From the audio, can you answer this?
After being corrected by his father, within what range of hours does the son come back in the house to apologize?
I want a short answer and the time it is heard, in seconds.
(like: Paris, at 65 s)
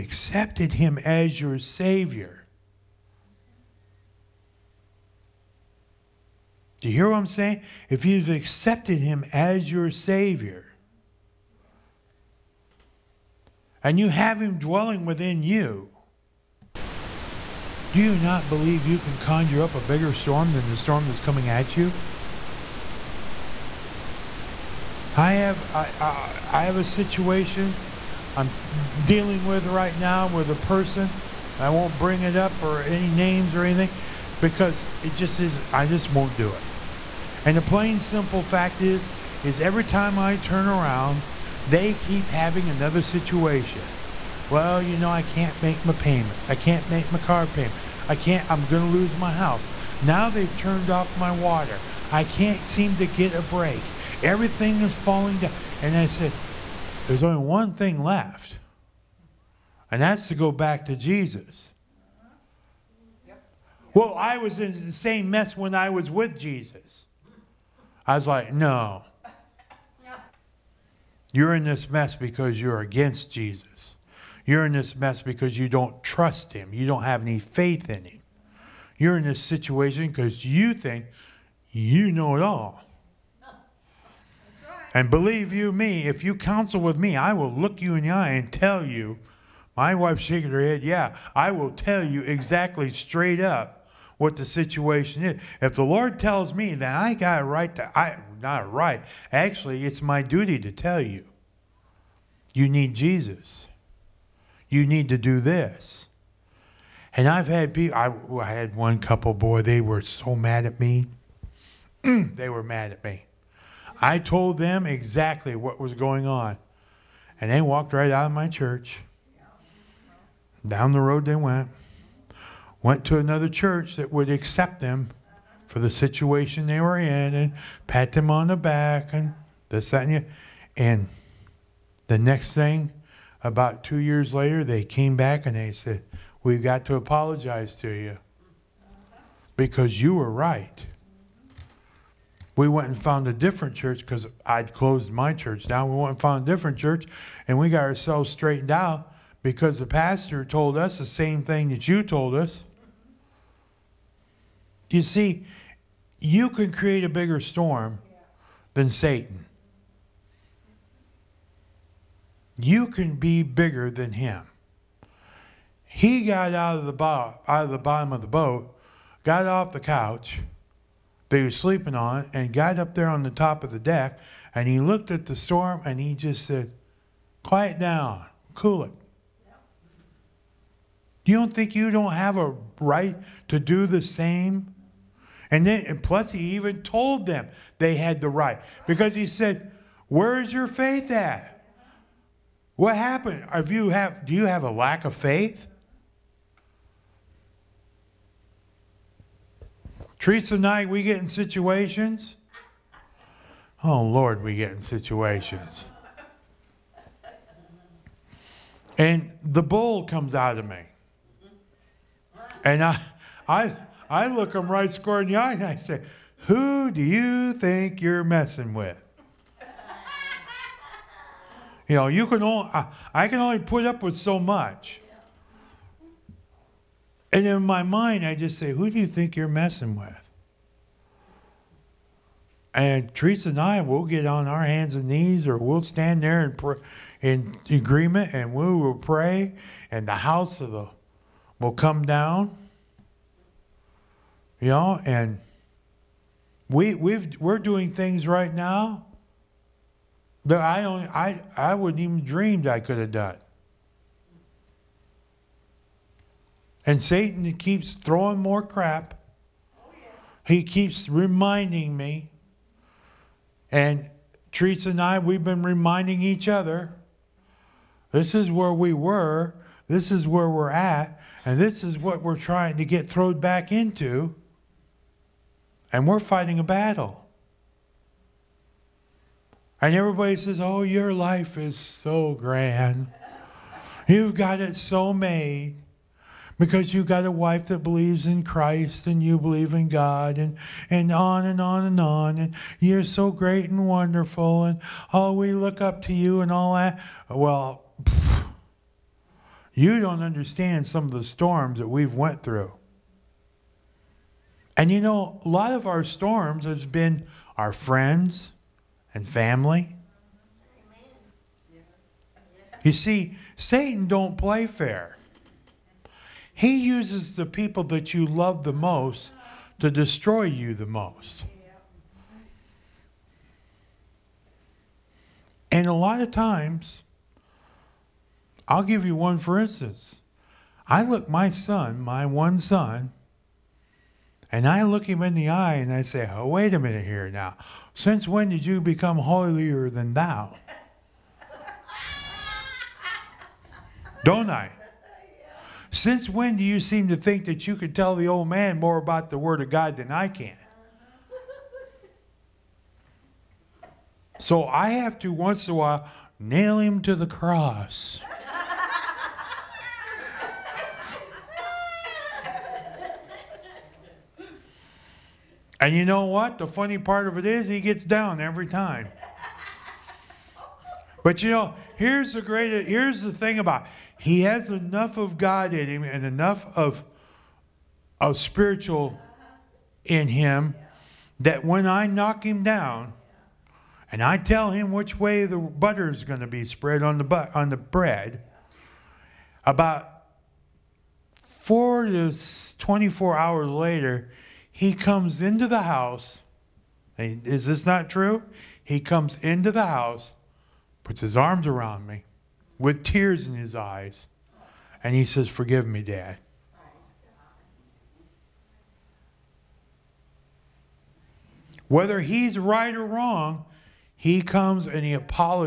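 4 to 24 hours, at 391 s.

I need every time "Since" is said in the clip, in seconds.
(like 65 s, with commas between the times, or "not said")
337 s, 345 s.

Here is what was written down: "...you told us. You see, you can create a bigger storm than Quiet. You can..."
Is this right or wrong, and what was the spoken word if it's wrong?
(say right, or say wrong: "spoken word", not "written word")
wrong: "Satan", not "Quiet".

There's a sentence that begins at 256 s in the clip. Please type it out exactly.
And Satan keeps throwing more crap.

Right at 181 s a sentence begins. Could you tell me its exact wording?
You don't think you don't have a right to do the same?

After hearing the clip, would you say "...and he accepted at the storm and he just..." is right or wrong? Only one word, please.
wrong.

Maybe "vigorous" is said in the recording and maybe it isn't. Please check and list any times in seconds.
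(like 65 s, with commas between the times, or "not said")
not said.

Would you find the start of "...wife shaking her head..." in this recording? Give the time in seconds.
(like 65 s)
89 s.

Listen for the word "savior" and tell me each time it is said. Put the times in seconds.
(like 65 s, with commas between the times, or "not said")
1 s, 9 s.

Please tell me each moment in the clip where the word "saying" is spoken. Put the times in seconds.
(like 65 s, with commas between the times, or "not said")
7 s.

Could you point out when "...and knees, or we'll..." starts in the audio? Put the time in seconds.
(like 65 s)
234 s.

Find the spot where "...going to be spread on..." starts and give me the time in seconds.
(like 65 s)
386 s.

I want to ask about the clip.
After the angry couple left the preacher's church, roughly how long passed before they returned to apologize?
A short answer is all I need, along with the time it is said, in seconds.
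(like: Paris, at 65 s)
About 2 years, at 133 s.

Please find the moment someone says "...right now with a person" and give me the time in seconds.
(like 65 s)
29 s.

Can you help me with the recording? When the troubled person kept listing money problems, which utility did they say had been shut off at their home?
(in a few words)
Water.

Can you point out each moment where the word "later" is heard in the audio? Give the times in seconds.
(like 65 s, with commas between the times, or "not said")
134 s, 393 s.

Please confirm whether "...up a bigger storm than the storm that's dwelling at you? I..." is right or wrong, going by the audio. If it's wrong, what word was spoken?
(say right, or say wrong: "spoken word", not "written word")
wrong: "coming", not "dwelling".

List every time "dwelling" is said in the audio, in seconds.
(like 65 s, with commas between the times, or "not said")
14 s.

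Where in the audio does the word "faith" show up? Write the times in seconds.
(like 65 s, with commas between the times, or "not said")
77 s, 190 s, 195 s.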